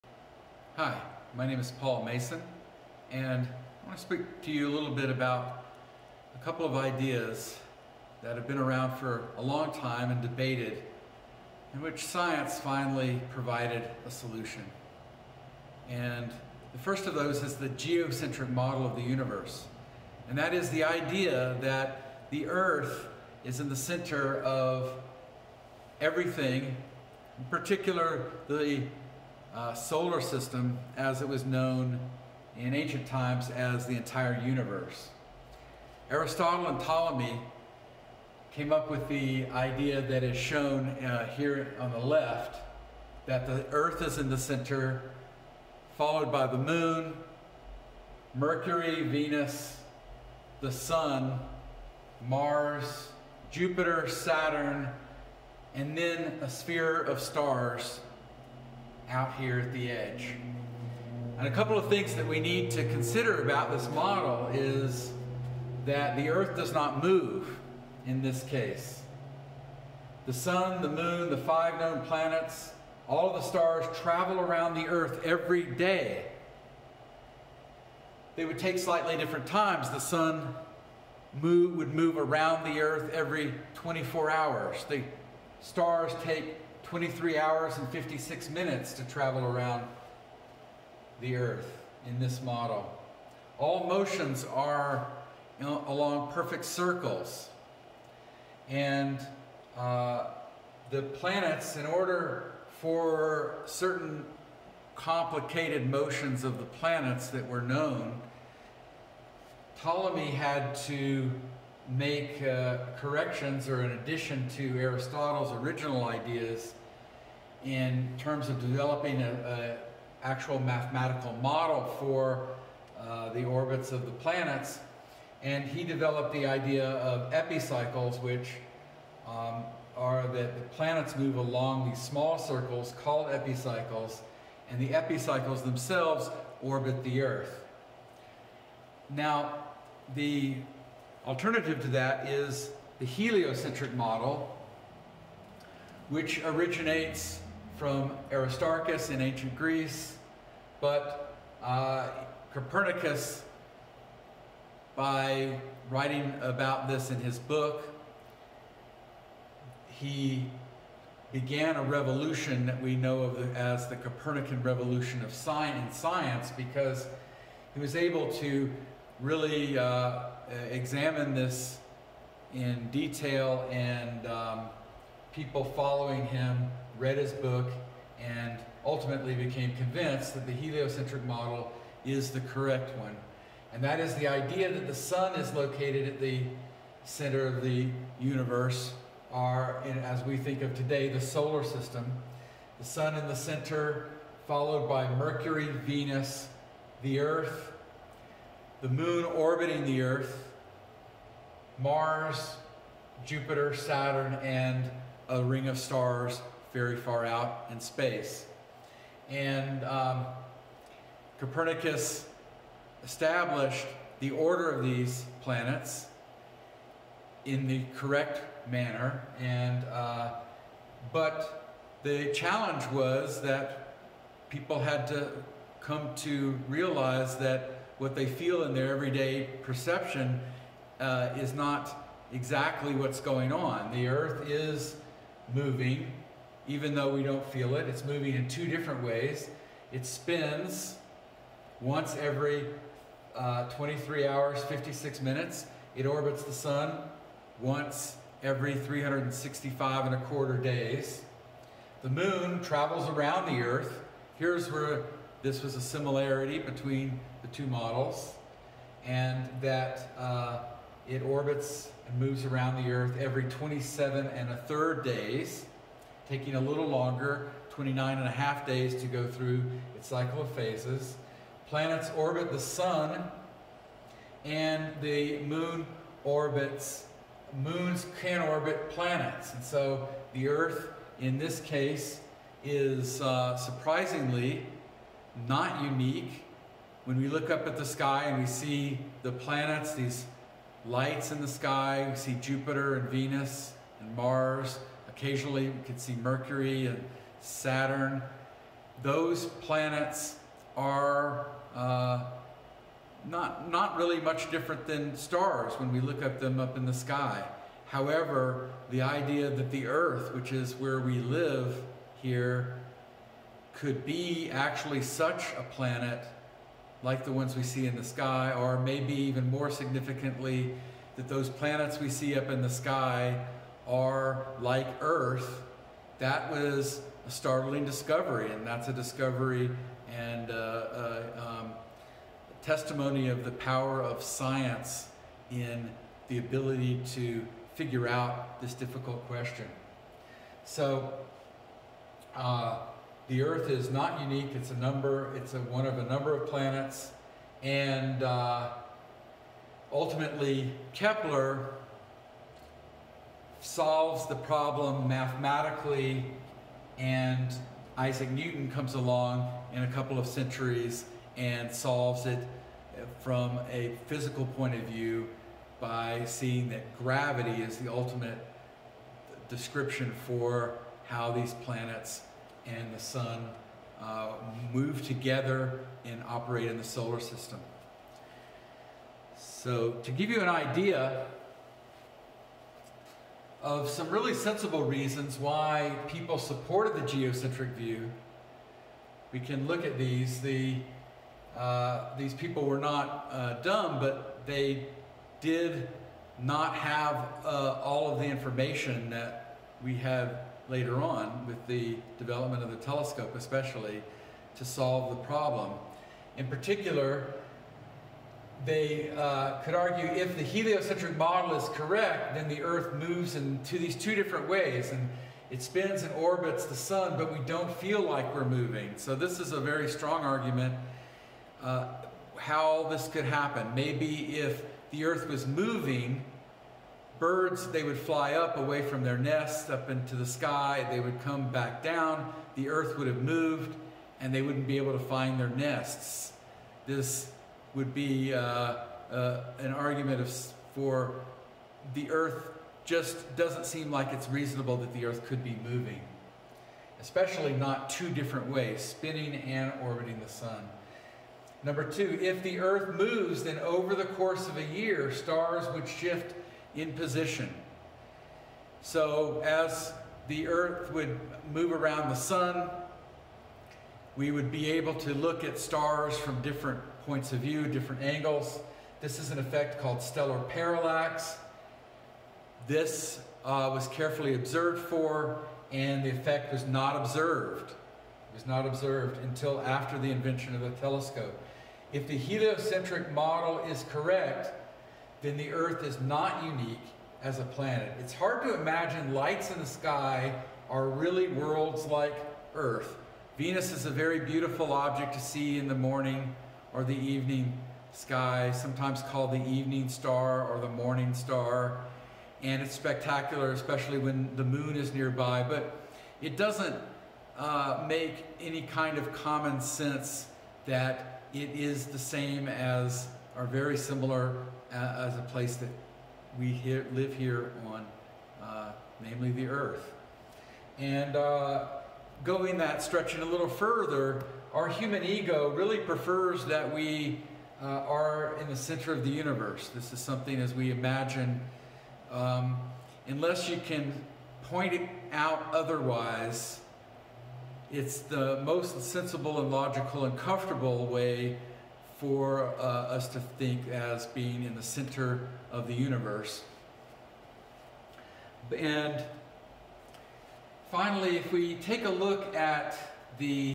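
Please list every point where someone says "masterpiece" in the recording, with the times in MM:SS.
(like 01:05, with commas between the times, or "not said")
not said.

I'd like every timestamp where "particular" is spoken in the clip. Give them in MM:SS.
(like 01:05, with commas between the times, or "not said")
00:27, 06:46.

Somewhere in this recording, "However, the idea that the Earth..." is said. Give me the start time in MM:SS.
05:07.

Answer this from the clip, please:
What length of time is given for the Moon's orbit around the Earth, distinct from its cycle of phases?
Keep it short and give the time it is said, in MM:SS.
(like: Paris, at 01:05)
27 and a third days, at 04:23.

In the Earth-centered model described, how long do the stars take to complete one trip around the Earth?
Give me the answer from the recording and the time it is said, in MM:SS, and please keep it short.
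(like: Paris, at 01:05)
23 hours and 56 minutes, at 01:26.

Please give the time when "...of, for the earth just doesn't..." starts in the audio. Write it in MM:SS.
07:20.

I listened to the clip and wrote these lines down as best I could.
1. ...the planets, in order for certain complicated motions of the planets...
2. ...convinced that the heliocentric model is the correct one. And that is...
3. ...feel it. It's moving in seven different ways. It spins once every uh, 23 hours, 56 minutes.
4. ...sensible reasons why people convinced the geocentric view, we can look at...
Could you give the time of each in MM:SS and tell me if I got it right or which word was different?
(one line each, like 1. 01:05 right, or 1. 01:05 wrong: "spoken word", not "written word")
1. 01:40 right
2. 02:59 right
3. 03:57 wrong: "two", not "seven"
4. 06:24 wrong: "supported", not "convinced".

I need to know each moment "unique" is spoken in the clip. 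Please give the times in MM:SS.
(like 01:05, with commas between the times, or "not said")
04:45, 05:44, 08:06.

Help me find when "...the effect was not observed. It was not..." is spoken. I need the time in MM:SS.
07:56.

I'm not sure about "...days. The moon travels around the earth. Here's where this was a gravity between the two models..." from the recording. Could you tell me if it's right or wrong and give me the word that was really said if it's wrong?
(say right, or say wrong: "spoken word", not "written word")
wrong: "similarity", not "gravity".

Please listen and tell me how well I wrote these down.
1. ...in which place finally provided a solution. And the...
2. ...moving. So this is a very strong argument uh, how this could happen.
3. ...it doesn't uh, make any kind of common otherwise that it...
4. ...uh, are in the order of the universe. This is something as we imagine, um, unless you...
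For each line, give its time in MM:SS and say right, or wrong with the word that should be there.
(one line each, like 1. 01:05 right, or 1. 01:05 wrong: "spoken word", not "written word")
1. 00:11 wrong: "science", not "place"
2. 06:58 right
3. 08:26 wrong: "sense", not "otherwise"
4. 08:47 wrong: "center", not "order".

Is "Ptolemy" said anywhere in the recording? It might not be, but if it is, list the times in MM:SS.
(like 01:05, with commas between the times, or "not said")
00:36, 01:49.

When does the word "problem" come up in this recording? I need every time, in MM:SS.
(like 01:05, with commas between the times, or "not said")
05:54, 06:45.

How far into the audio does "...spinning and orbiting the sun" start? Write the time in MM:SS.
07:28.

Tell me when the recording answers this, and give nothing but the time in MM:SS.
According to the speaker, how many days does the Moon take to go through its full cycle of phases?
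04:27.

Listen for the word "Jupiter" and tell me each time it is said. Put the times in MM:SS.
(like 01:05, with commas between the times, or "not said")
00:53, 03:23, 04:52.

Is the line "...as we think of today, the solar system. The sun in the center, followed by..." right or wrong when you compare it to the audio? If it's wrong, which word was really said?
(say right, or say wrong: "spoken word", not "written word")
right.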